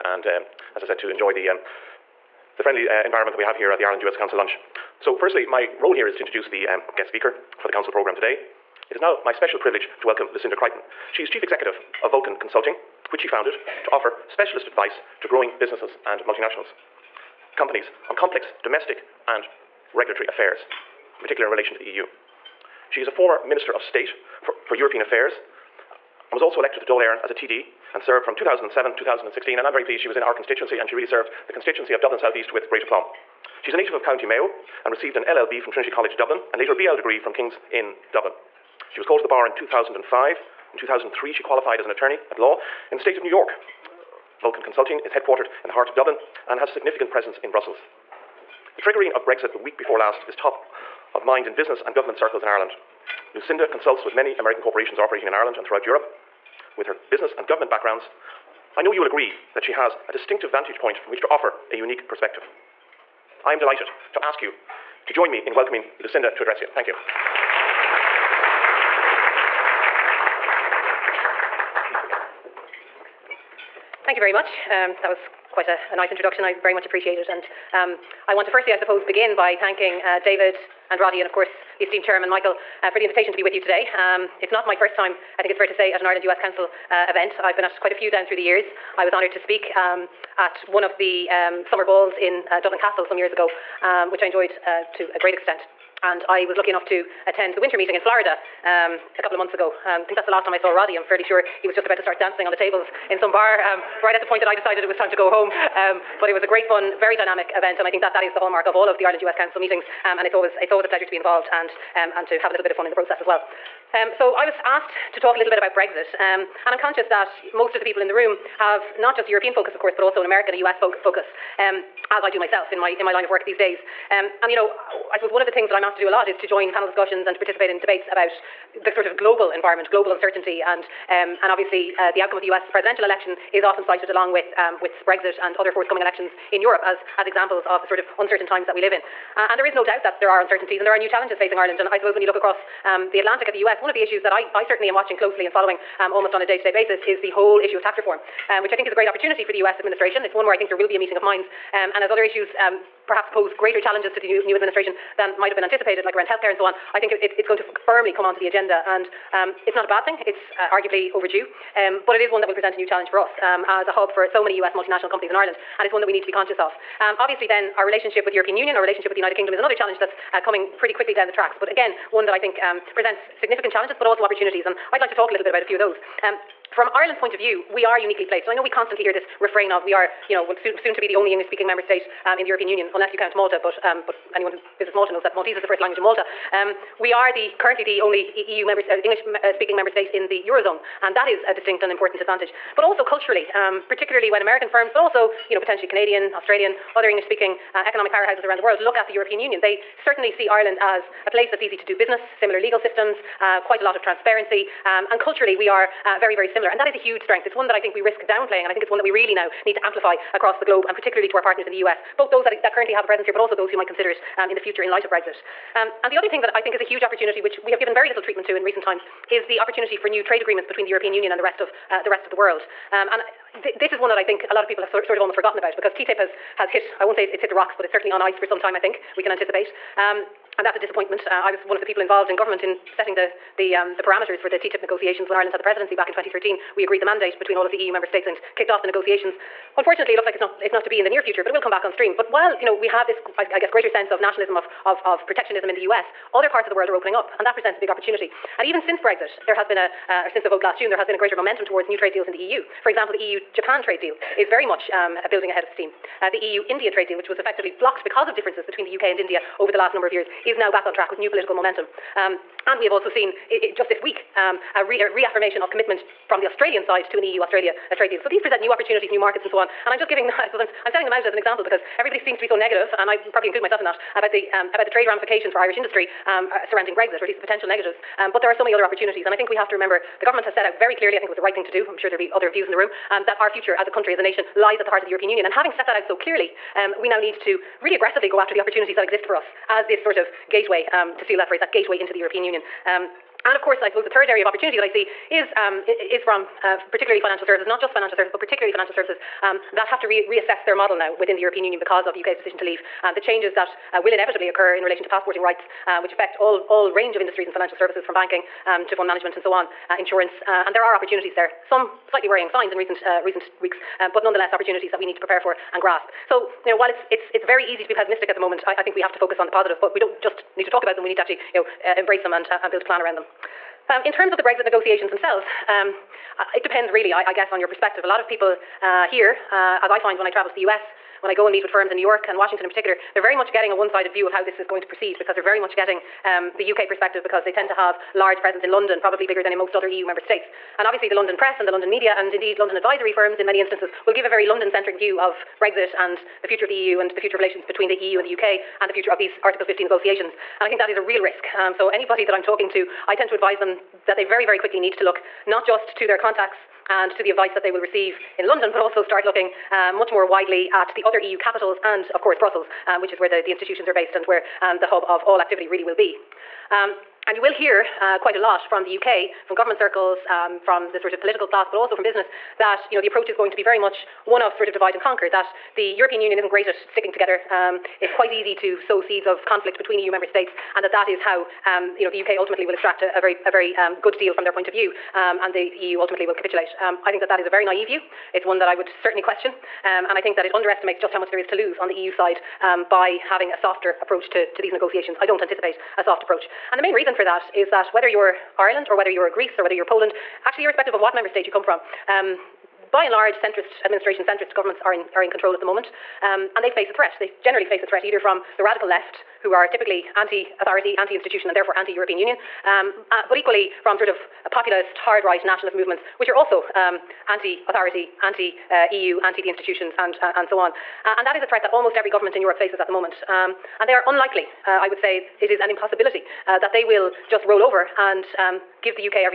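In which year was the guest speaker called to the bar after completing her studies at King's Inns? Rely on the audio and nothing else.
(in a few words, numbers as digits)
2005.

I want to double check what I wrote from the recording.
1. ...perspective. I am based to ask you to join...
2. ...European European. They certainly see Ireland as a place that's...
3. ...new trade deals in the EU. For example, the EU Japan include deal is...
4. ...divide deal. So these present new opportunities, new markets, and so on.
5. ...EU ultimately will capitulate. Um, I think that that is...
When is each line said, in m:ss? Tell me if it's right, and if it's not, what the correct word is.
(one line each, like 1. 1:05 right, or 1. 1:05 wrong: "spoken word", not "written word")
1. 1:02 wrong: "delighted", not "based"
2. 3:19 wrong: "Union", not "European"
3. 4:11 wrong: "trade", not "include"
4. 4:27 wrong: "trade", not "divide"
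5. 6:25 right.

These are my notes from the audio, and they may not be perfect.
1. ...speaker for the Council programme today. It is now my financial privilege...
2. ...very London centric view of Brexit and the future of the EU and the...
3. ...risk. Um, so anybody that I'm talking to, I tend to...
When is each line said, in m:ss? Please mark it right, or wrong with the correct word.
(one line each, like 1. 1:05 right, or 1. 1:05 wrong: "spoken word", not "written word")
1. 0:07 wrong: "special", not "financial"
2. 5:44 right
3. 5:51 right.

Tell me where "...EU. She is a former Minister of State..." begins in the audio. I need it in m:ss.
0:21.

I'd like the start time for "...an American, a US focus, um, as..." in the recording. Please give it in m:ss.
2:00.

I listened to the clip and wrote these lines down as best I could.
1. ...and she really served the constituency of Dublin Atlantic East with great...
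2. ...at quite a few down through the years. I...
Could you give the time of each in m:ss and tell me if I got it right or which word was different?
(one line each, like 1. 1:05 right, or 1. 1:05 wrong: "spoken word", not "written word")
1. 0:30 wrong: "South", not "Atlantic"
2. 1:27 right.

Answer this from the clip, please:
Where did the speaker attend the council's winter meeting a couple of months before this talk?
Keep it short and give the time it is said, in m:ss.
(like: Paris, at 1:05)
Florida, at 1:37.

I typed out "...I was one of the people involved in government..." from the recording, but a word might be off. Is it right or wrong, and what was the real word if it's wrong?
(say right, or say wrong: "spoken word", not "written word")
right.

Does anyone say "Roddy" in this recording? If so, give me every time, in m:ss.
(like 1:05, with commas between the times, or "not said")
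1:20, 1:40.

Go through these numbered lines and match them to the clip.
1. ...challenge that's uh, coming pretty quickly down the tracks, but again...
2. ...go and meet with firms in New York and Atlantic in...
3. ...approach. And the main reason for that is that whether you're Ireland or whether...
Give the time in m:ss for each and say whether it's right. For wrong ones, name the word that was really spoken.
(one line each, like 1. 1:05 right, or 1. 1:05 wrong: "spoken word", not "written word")
1. 2:49 right
2. 5:31 wrong: "Washington", not "Atlantic"
3. 6:36 right.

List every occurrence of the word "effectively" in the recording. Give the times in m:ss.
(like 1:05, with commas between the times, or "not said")
4:17.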